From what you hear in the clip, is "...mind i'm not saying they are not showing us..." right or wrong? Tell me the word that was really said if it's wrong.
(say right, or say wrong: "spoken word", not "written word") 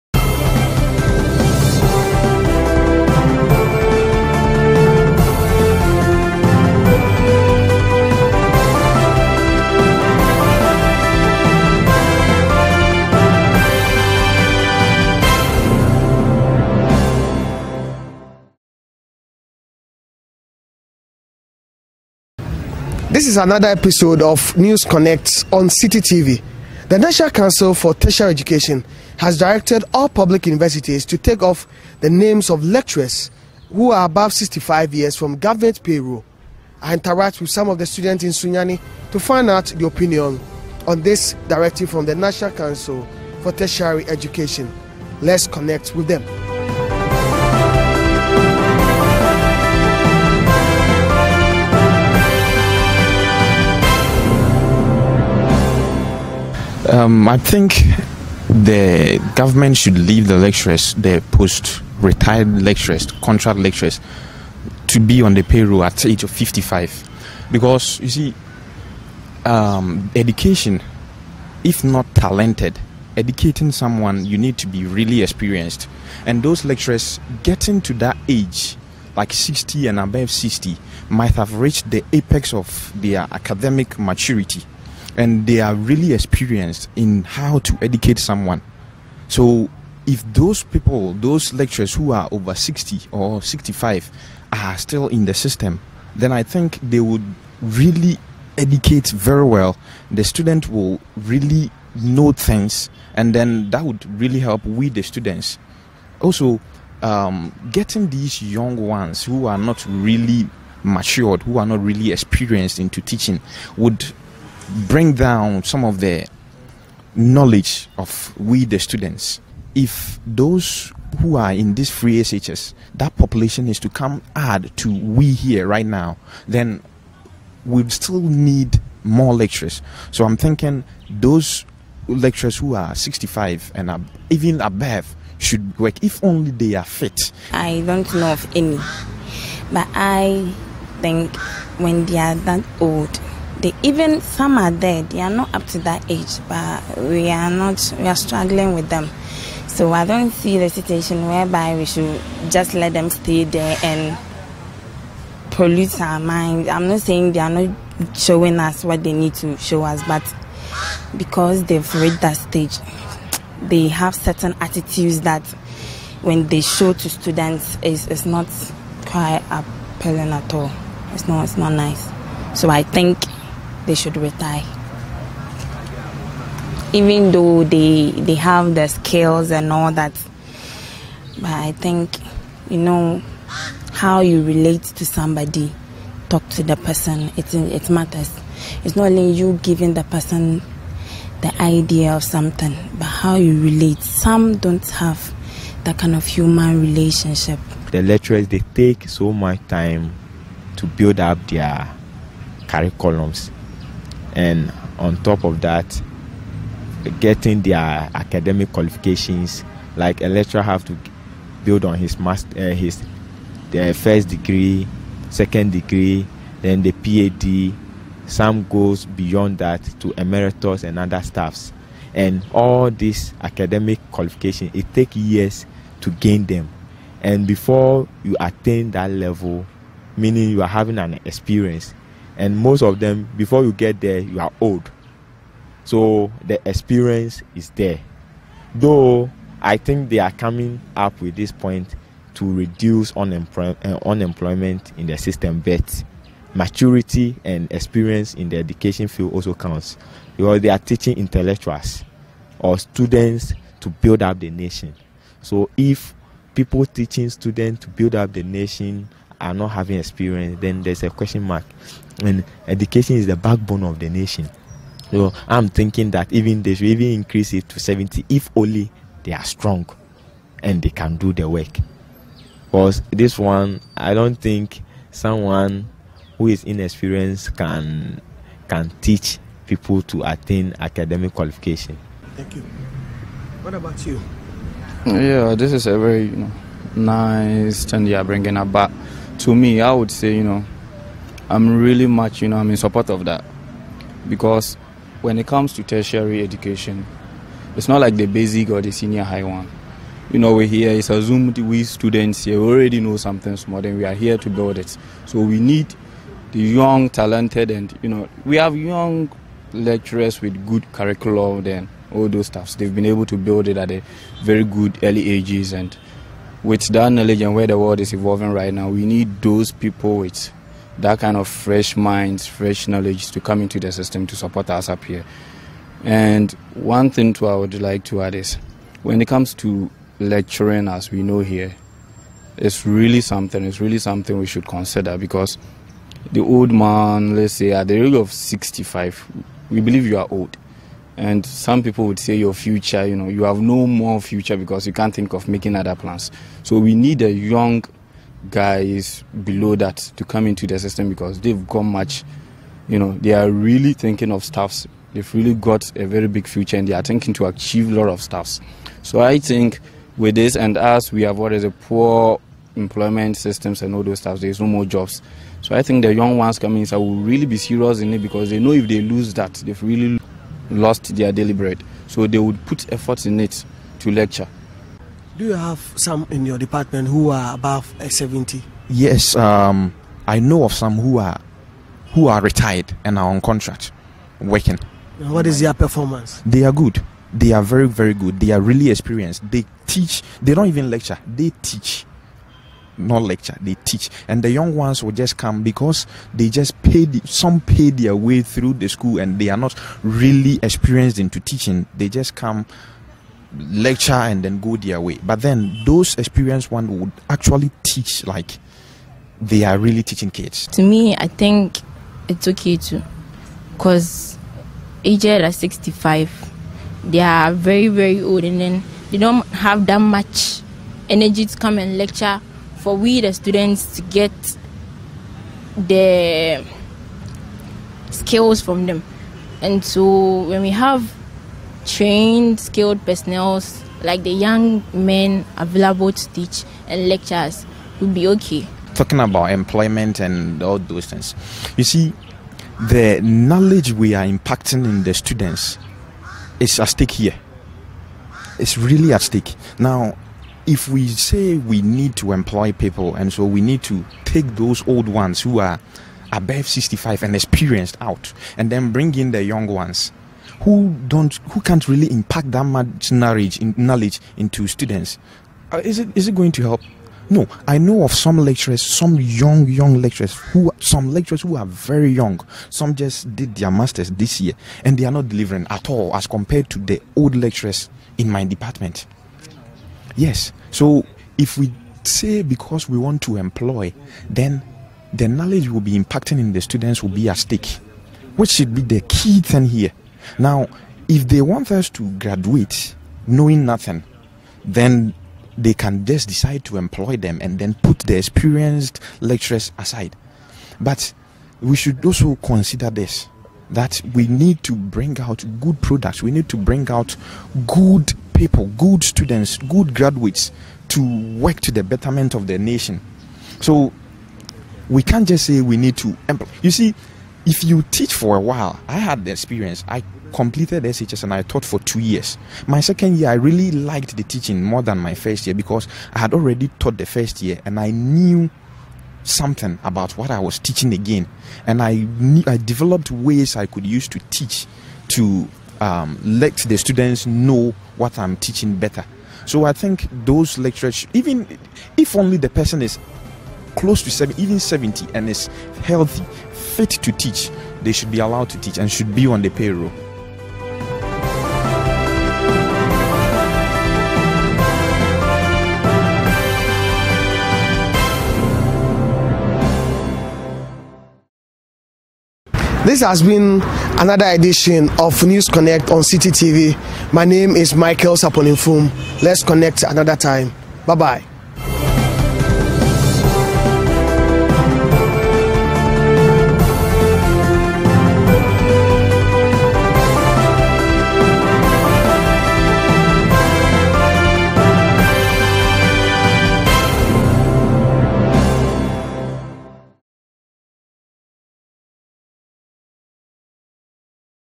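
right.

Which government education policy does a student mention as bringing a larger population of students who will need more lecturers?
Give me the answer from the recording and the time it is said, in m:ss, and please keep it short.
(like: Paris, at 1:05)
Free SHS, at 2:01.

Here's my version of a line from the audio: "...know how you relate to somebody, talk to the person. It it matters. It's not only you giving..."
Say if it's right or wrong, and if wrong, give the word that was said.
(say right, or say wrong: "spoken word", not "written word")
right.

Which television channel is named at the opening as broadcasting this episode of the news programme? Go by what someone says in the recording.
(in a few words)
Citi TV.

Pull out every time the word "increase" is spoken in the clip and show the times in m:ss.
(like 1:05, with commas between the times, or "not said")
4:27.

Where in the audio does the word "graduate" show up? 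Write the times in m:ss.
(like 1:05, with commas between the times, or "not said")
8:12, 8:29.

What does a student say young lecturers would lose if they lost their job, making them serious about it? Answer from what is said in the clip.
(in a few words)
Their daily bread.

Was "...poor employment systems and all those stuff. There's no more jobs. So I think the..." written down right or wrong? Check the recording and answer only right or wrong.
right.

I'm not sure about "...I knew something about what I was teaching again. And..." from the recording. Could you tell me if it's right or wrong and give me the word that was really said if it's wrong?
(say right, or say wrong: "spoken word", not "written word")
right.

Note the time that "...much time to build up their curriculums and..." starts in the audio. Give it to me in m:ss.
3:19.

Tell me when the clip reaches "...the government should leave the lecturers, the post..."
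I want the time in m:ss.
0:58.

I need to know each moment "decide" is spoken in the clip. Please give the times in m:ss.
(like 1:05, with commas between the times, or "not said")
8:16.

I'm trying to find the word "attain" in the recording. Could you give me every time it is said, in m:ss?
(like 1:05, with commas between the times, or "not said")
3:48, 4:40.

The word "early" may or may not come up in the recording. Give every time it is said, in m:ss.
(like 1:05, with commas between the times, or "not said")
5:15.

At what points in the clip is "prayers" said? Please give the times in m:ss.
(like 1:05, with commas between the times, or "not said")
not said.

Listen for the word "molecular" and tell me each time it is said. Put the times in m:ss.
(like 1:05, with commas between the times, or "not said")
not said.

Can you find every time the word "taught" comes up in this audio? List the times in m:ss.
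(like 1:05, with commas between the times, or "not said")
8:41, 8:46.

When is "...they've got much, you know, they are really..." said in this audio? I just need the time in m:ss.
5:51.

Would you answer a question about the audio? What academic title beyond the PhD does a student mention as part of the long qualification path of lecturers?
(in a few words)
Emeritus.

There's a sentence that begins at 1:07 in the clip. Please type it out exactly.
Because, you see, um, education, if not talented, educating someone, you need to be really experienced.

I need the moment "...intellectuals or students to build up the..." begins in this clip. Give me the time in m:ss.
4:11.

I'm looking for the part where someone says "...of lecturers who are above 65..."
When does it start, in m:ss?
0:32.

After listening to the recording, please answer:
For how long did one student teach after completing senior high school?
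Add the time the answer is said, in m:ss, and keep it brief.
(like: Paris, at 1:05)
2 years, at 8:41.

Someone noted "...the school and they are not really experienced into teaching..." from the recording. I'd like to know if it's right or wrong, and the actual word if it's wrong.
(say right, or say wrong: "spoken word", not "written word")
right.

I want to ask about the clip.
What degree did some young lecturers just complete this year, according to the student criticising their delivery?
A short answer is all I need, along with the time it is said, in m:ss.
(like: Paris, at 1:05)
Masters, at 7:53.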